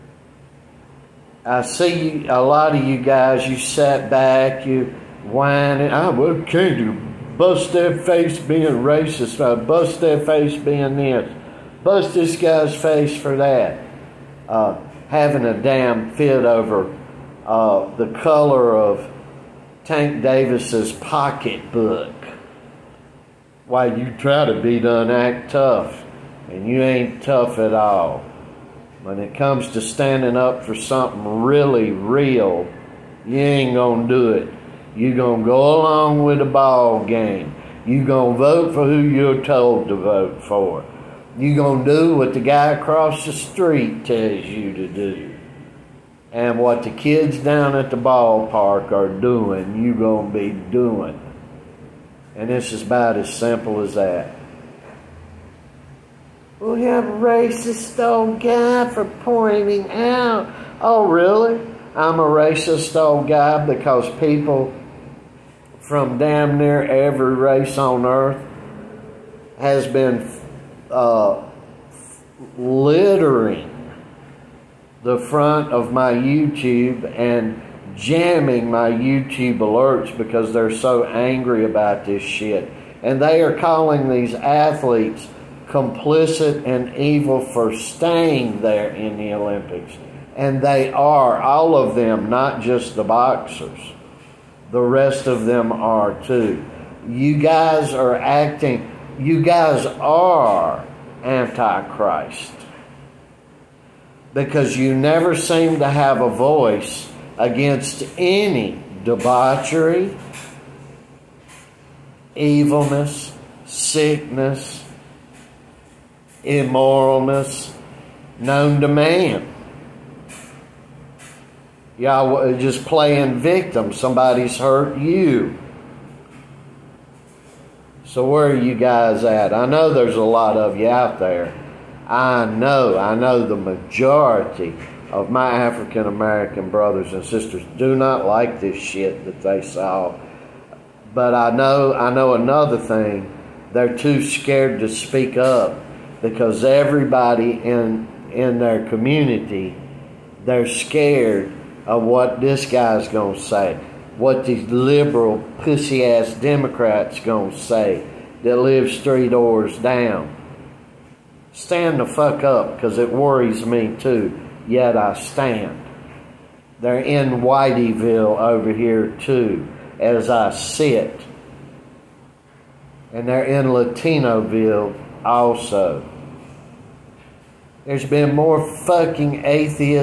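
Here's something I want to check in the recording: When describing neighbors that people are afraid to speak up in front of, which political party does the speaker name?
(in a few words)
Democrats.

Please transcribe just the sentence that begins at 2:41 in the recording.
Stand the fuck up because it worries me too, yet I stand.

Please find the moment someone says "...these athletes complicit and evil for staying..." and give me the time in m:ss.
1:24.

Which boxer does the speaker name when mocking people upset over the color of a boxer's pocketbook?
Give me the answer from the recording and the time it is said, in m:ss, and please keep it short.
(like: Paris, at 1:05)
Tank Davis, at 0:19.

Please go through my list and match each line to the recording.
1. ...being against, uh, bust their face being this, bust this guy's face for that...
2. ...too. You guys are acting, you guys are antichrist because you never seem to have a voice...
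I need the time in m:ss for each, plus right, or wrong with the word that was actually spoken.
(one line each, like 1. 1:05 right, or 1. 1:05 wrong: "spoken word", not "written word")
1. 0:08 wrong: "racist", not "against"
2. 1:36 right.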